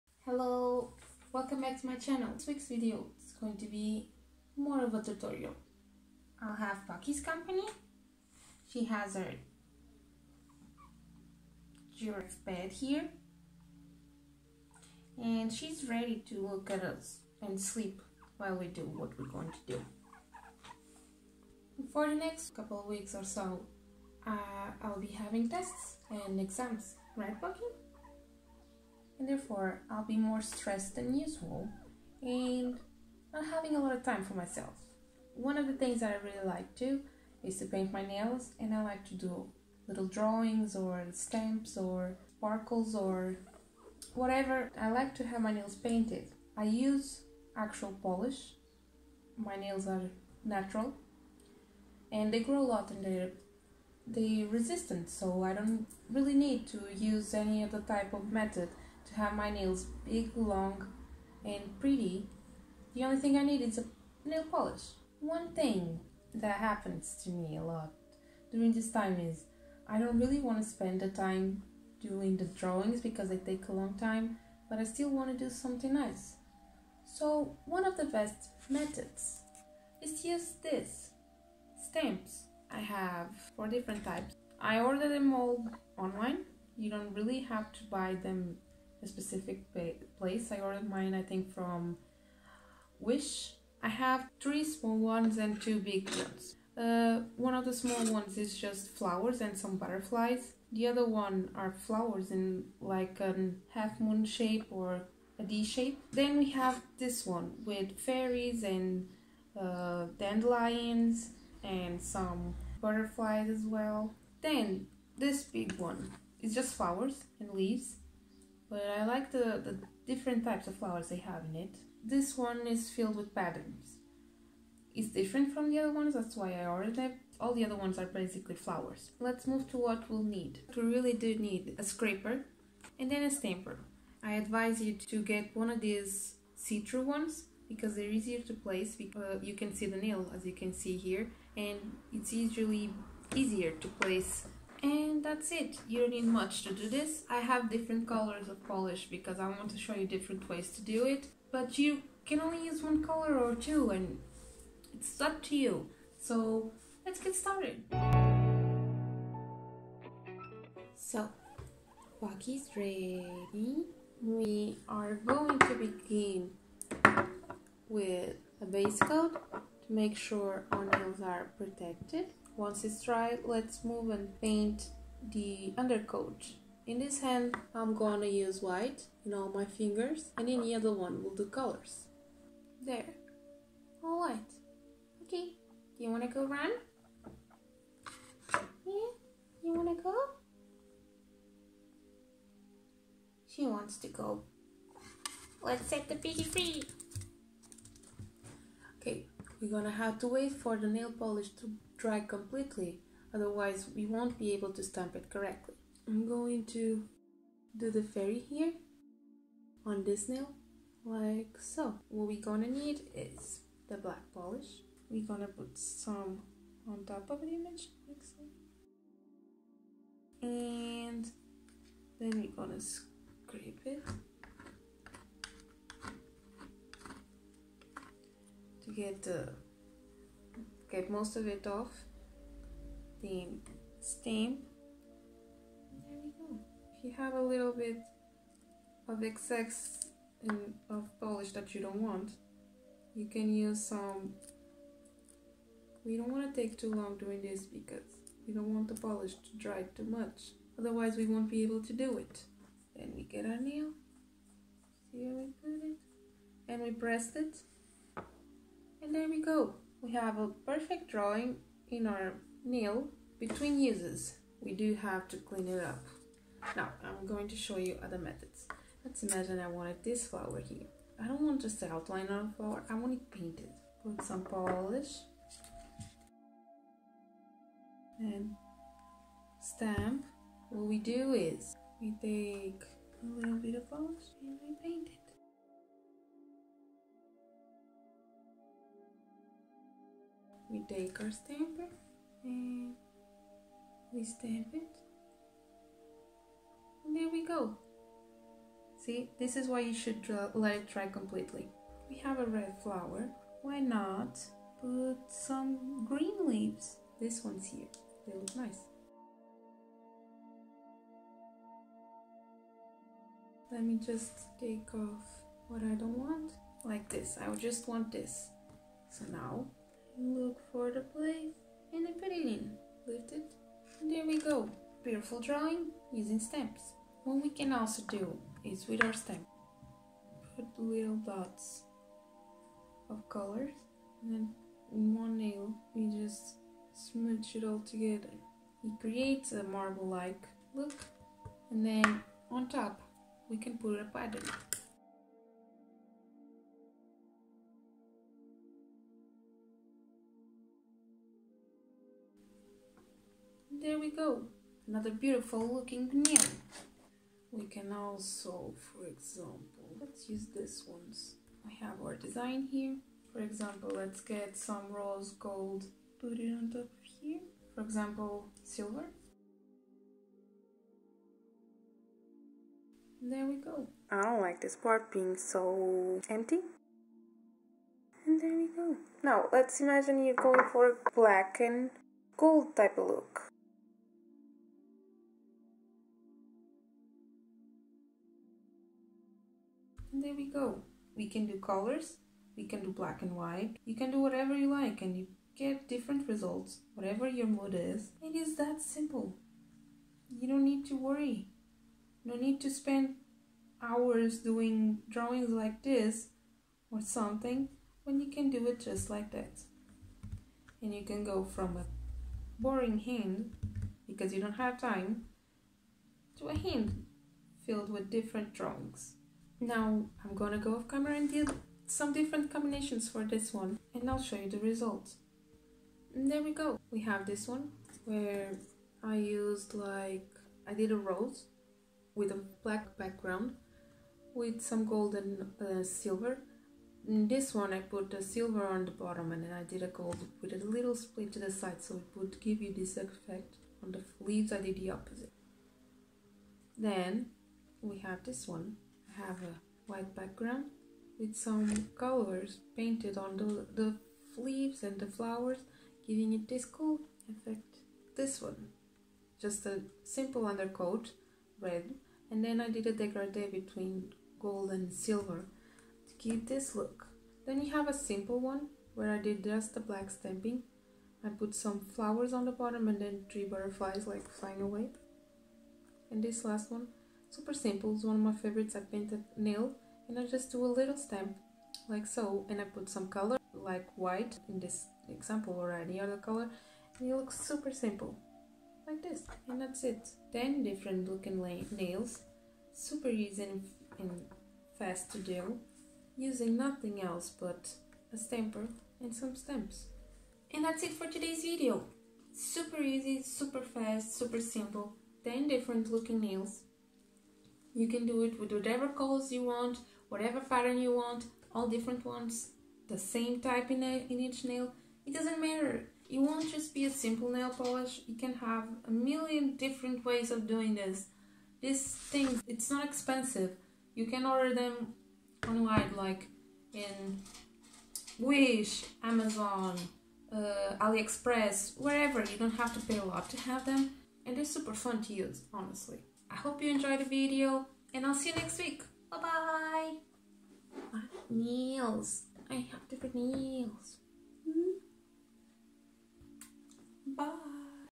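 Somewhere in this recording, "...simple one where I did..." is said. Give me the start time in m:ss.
7:47.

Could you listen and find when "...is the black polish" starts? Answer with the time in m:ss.
3:33.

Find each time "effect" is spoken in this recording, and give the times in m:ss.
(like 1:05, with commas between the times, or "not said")
7:22, 7:37.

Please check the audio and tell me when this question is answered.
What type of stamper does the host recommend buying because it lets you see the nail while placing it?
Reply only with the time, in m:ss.
2:16.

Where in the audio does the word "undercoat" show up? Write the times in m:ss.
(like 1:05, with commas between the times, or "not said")
2:55, 7:40.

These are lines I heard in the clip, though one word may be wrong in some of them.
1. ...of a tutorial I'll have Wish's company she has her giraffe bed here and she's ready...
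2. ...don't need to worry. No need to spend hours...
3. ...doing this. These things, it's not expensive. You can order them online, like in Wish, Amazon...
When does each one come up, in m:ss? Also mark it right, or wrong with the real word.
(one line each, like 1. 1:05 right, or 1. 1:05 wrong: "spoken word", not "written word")
1. 0:04 wrong: "Bucky", not "Wish"
2. 6:40 right
3. 8:40 right.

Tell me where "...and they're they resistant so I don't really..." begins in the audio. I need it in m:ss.
0:52.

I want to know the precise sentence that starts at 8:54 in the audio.
And they're super fun to use, honestly.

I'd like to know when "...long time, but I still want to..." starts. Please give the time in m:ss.
1:13.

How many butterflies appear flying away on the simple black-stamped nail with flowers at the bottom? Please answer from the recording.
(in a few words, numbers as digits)
3.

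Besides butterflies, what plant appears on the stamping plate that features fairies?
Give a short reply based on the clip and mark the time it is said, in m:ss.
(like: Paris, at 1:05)
dandelions, at 1:50.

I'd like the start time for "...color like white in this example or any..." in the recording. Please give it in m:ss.
8:03.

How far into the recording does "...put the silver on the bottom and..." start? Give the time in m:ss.
7:17.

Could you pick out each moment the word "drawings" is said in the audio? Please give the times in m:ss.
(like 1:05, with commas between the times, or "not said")
0:40, 1:12, 4:21, 5:25, 6:45, 6:58.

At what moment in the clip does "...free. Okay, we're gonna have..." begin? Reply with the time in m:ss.
3:16.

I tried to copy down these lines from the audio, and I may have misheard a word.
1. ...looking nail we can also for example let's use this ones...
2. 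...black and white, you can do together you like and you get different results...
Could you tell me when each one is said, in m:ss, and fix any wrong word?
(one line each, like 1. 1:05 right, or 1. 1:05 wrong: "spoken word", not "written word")
1. 5:55 right
2. 6:32 wrong: "whatever", not "together".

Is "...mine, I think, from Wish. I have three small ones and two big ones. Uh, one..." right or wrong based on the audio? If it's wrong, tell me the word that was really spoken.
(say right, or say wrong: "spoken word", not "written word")
right.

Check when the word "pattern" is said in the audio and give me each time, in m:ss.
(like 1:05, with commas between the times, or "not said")
2:03, 5:44, 8:30.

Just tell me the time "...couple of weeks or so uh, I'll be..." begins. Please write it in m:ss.
0:22.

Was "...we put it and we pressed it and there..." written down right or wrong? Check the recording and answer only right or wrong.
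right.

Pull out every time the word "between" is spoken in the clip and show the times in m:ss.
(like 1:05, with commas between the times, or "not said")
4:23, 7:43.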